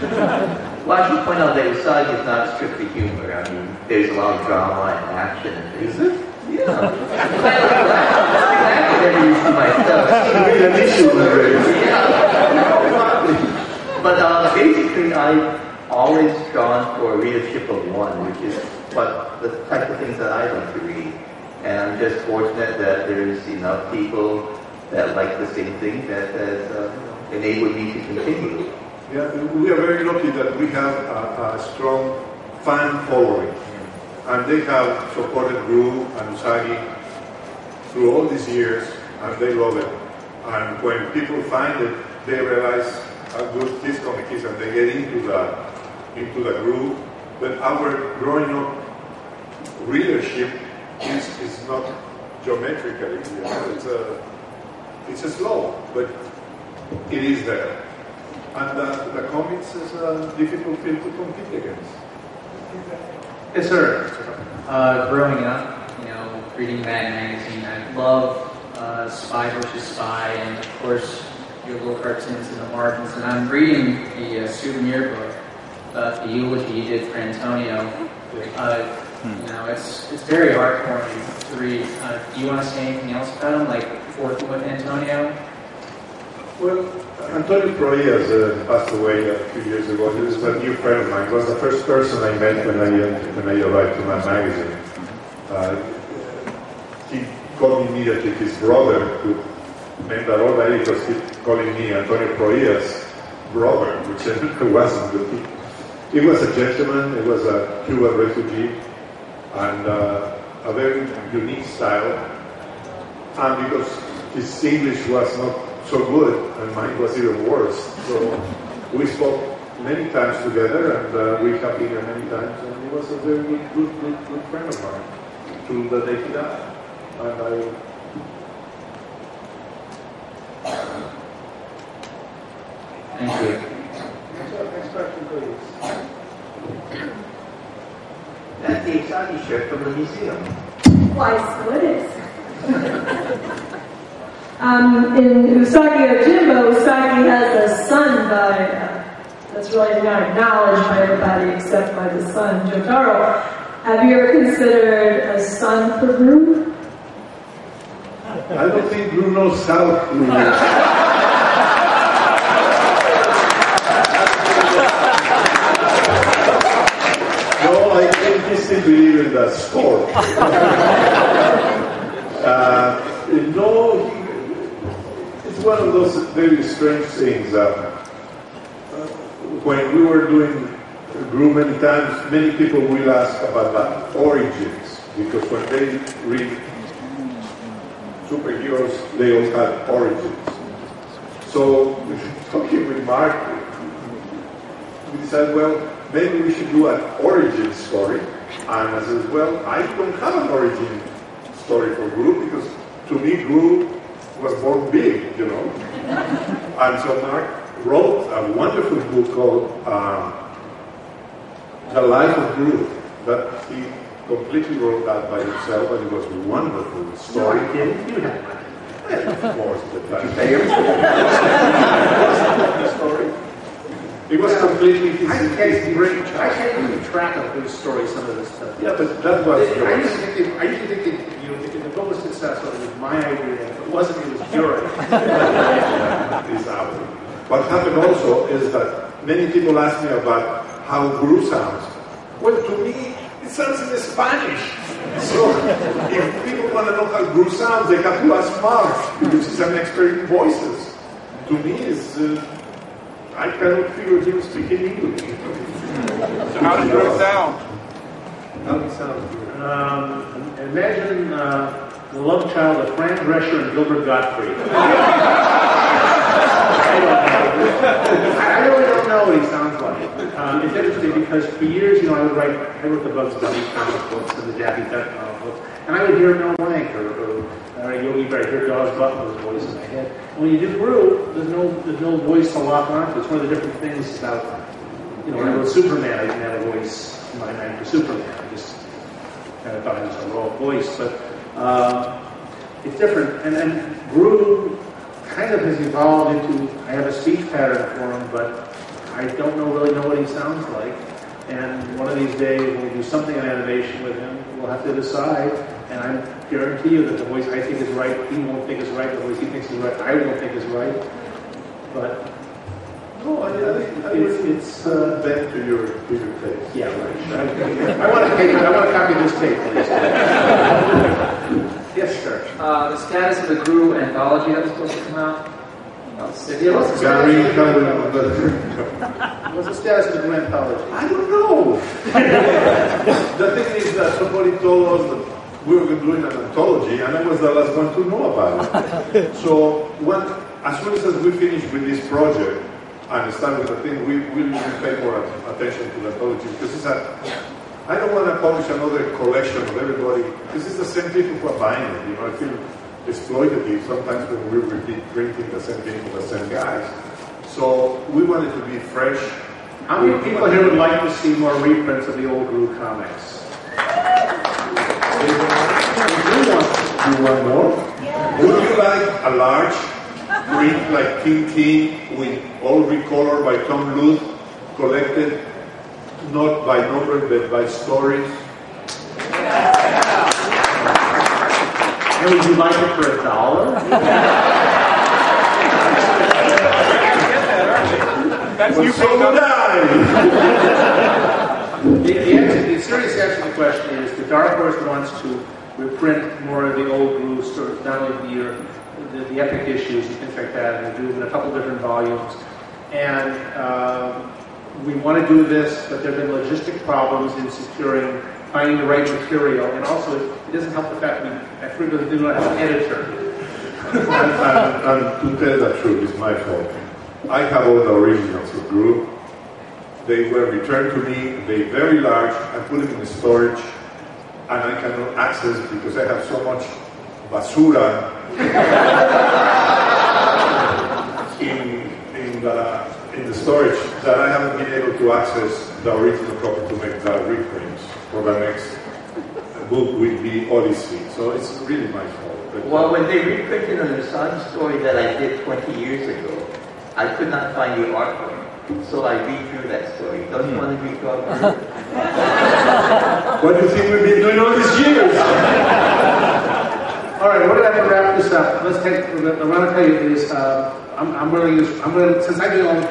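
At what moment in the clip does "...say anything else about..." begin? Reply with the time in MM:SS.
01:22.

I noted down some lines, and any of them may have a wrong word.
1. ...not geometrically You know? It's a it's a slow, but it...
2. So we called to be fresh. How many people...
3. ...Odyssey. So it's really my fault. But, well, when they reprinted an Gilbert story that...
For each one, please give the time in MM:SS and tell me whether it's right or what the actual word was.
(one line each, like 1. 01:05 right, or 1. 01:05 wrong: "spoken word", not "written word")
1. 00:51 right
2. 05:57 wrong: "wanted", not "called"
3. 07:20 wrong: "Assange", not "Gilbert".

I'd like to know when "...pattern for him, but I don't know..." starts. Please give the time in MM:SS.
04:57.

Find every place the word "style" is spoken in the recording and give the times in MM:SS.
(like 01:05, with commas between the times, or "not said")
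01:51.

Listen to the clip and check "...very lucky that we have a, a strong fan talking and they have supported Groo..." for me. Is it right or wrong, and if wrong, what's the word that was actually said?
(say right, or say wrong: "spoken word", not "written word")
wrong: "following", not "talking".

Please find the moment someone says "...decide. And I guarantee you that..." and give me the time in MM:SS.
05:04.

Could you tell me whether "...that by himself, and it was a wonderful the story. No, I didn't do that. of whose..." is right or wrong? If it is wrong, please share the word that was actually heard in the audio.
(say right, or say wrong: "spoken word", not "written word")
wrong: "course", not "whose".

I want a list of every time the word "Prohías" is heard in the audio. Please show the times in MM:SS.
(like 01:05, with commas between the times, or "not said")
01:27, 01:42.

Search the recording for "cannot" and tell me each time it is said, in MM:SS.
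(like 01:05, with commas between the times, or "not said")
04:13, 07:04.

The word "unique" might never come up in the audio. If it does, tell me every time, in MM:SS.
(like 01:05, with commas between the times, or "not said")
01:51.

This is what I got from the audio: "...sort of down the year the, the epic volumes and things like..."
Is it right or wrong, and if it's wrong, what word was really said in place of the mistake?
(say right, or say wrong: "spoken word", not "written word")
wrong: "issues", not "volumes".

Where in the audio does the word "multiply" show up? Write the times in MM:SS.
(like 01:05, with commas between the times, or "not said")
not said.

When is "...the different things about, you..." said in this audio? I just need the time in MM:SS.
04:43.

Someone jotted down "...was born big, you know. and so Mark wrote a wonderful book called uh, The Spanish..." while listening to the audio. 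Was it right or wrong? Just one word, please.
wrong.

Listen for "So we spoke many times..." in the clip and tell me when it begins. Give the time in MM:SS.
01:58.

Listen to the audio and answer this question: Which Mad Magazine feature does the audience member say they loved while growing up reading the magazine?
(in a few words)
Spy versus Spy.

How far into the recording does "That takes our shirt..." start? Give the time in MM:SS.
02:18.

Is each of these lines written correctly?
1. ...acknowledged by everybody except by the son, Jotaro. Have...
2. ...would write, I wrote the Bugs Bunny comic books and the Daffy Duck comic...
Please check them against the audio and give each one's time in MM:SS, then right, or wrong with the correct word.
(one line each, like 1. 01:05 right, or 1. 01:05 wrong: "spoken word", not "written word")
1. 02:30 right
2. 04:32 right.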